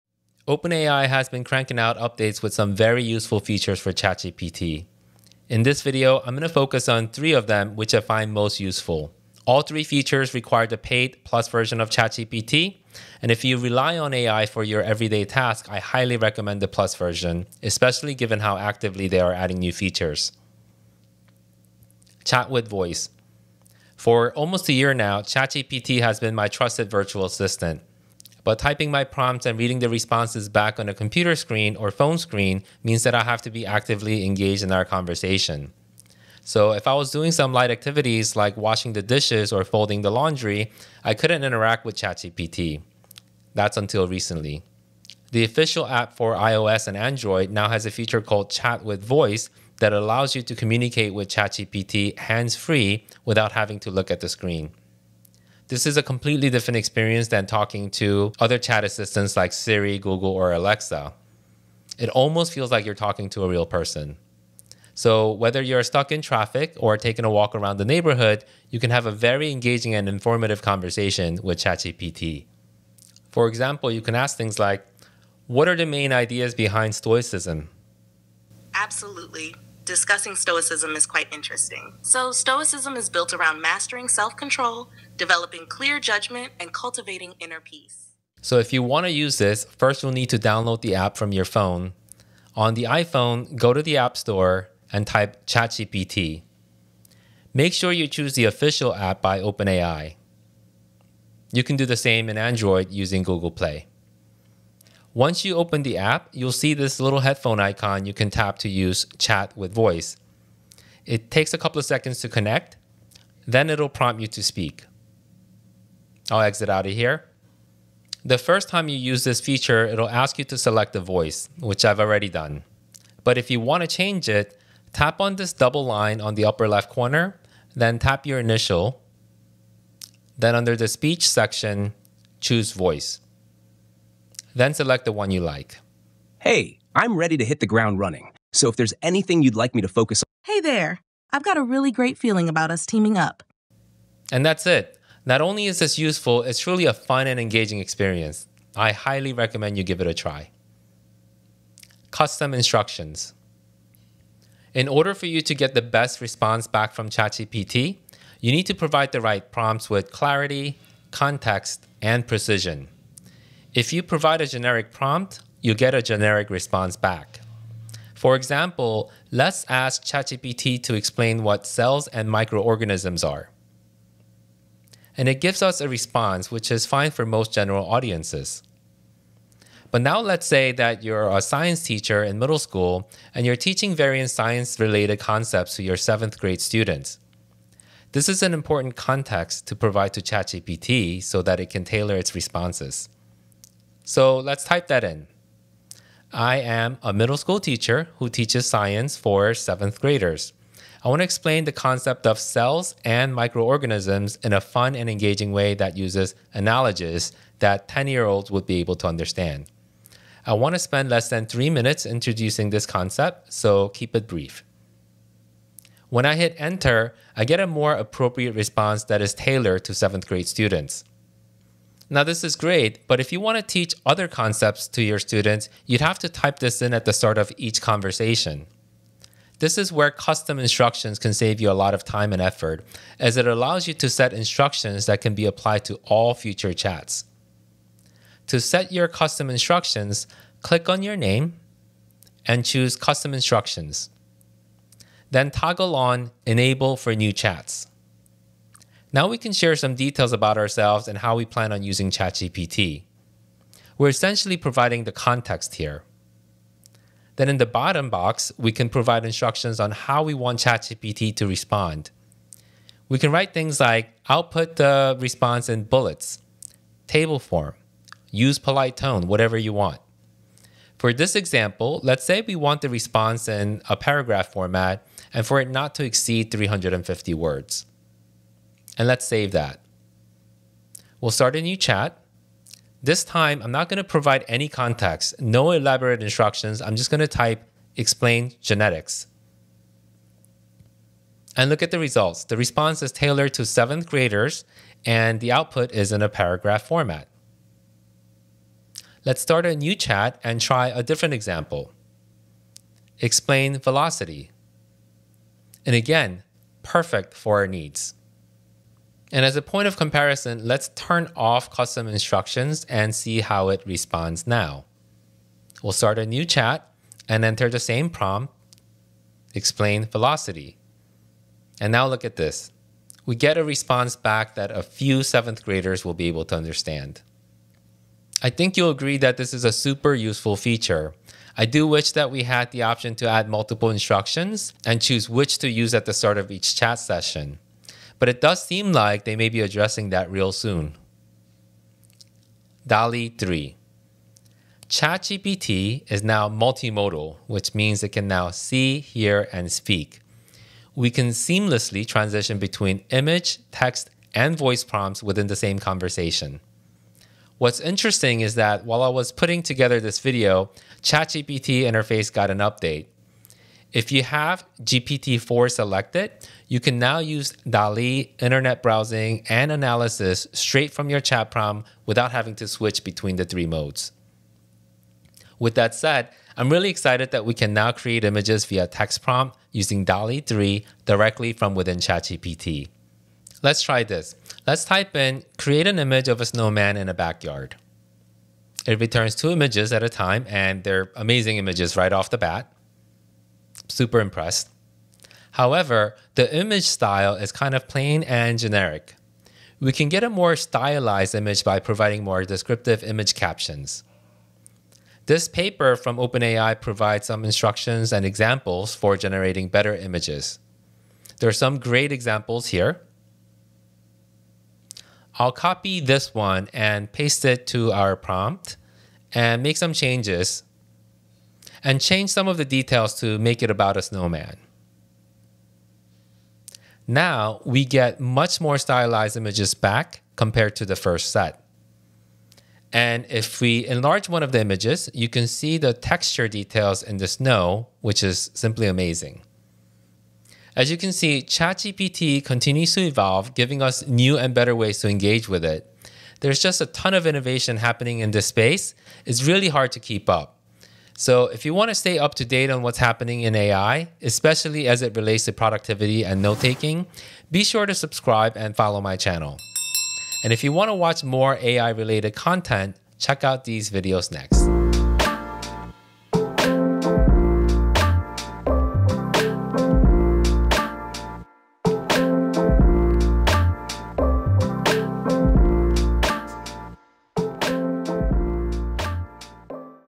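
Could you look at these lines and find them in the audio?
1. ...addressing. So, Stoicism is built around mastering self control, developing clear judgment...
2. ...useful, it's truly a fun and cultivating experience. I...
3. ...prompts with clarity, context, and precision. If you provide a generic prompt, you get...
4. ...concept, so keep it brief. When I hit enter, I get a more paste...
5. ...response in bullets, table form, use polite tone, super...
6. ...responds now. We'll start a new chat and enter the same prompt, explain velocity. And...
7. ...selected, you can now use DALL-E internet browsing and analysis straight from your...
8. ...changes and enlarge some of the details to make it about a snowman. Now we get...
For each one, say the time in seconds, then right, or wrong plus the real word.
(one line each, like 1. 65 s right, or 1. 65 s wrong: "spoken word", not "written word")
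1. 81 s wrong: "interesting", not "addressing"
2. 145 s wrong: "engaging", not "cultivating"
3. 159 s right
4. 212 s wrong: "appropriate", not "paste"
5. 265 s wrong: "whatever", not "super"
6. 313 s right
7. 365 s right
8. 419 s wrong: "change", not "enlarge".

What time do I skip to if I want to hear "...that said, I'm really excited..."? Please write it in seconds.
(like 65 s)
375 s.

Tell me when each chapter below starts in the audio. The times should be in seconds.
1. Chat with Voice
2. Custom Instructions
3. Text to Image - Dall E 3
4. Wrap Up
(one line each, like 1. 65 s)
1. 19 s
2. 150 s
3. 341 s
4. 440 s.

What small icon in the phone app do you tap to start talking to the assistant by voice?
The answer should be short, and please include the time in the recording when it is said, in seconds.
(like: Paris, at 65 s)
headphone icon, at 107 s.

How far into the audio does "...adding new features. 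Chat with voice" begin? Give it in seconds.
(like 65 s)
19 s.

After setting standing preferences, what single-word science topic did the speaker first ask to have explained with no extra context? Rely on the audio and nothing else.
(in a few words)
genetics.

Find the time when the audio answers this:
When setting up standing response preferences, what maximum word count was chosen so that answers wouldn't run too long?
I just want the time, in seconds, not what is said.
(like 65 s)
276 s.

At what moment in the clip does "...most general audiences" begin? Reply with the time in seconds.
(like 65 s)
177 s.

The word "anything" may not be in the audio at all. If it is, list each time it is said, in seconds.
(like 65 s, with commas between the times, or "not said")
139 s.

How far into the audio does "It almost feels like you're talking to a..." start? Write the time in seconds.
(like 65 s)
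61 s.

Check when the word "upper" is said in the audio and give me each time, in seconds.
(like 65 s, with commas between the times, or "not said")
126 s.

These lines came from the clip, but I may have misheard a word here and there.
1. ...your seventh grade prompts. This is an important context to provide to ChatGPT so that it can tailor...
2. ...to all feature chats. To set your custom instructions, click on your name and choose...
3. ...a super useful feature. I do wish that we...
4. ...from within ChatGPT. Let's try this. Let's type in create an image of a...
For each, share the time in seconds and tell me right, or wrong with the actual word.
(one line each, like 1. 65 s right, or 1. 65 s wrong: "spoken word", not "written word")
1. 185 s wrong: "students", not "prompts"
2. 235 s wrong: "future", not "feature"
3. 329 s right
4. 381 s right.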